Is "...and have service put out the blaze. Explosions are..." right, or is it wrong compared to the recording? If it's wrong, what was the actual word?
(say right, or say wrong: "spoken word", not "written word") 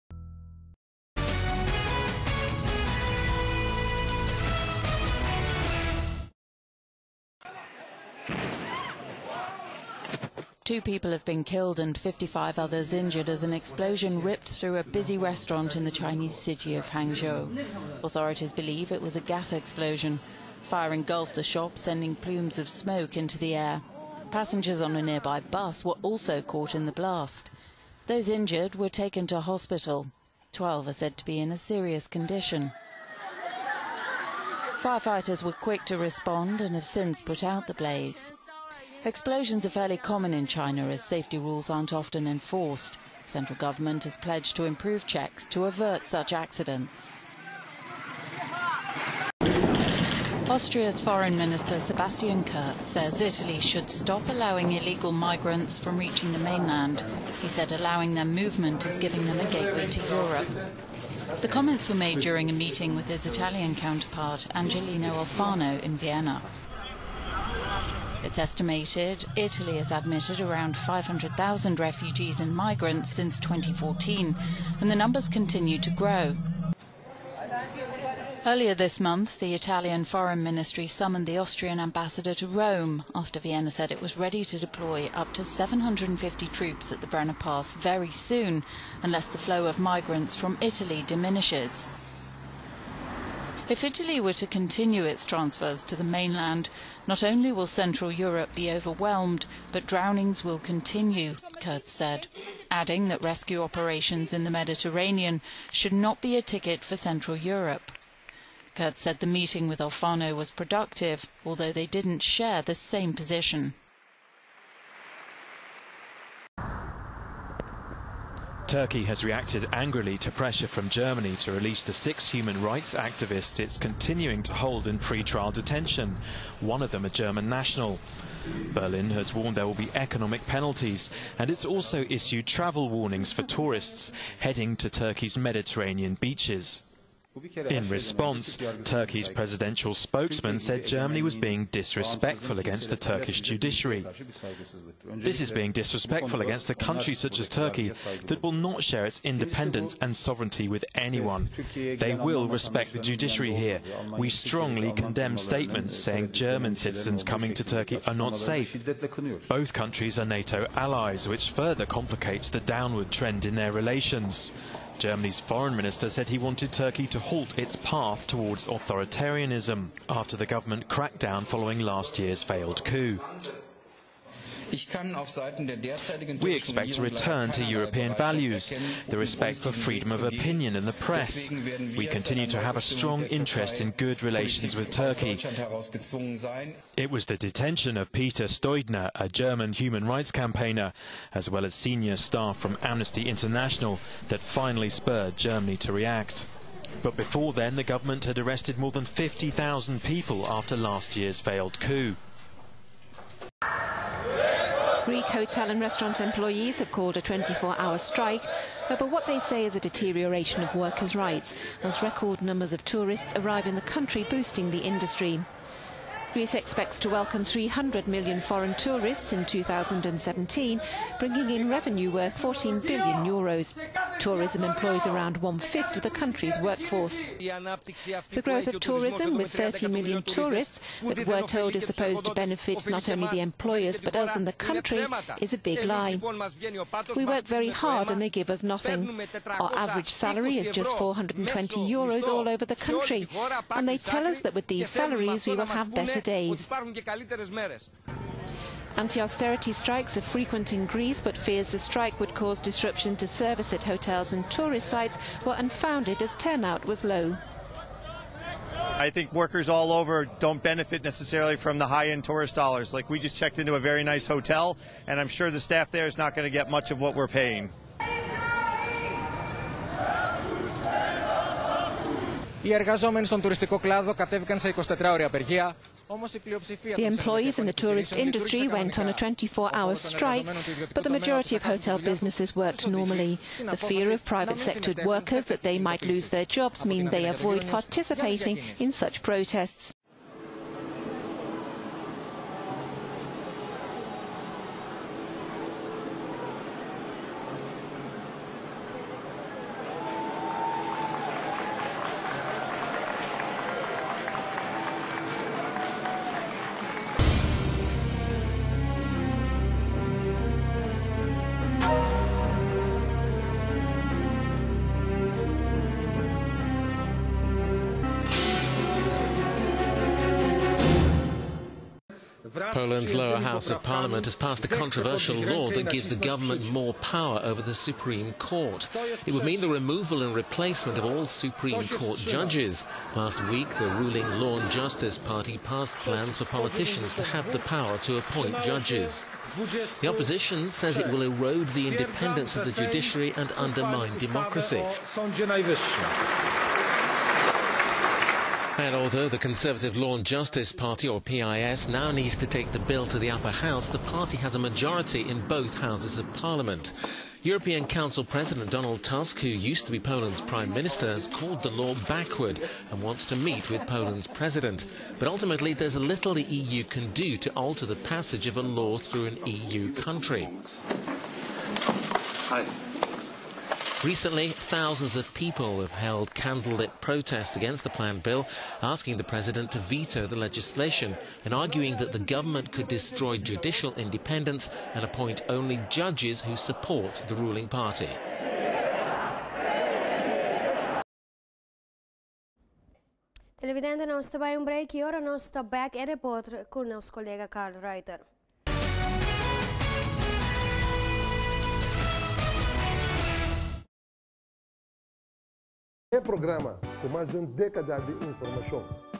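wrong: "since", not "service".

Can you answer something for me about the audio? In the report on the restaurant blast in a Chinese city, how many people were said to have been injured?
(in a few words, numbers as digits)
55.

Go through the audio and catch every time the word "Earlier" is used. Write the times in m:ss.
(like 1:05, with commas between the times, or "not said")
1:18.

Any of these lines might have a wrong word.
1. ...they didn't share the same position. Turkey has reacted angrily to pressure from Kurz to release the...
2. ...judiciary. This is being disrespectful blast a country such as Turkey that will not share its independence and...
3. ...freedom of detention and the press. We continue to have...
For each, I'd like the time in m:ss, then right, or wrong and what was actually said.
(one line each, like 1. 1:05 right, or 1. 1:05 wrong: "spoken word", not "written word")
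1. 1:51 wrong: "Germany", not "Kurz"
2. 2:23 wrong: "against", not "blast"
3. 2:59 wrong: "opinion", not "detention".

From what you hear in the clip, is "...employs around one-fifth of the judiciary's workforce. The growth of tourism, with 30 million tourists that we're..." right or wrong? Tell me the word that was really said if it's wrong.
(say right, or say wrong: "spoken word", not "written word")
wrong: "country", not "judiciary".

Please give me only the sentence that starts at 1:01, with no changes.
The comments were made during a meeting with his Italian counterpart, Angelino Alfano, in Vienna.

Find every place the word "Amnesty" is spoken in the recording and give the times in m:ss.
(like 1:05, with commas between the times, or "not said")
3:12.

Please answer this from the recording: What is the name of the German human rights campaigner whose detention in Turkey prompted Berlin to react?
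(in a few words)
Peter Steudner.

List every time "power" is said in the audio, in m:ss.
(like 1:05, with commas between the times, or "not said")
5:26, 5:37.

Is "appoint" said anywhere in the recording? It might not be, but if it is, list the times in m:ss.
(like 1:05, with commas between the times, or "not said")
5:38, 6:25.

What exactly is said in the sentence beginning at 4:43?
The fear of private sector workers that they might lose their jobs mean they avoid participating in such protests.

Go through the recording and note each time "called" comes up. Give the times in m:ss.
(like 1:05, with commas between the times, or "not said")
3:26, 6:01.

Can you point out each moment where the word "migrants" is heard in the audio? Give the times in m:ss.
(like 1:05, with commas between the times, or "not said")
0:55, 1:12, 1:29.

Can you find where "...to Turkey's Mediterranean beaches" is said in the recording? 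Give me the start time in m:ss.
2:14.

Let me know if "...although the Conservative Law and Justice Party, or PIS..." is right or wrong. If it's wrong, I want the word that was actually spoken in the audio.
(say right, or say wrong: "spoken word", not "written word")
right.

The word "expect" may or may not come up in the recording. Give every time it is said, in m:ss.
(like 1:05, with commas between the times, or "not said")
2:56, 3:36.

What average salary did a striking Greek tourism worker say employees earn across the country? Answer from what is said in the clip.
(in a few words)
420 euros.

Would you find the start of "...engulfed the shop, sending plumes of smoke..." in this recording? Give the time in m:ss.
0:20.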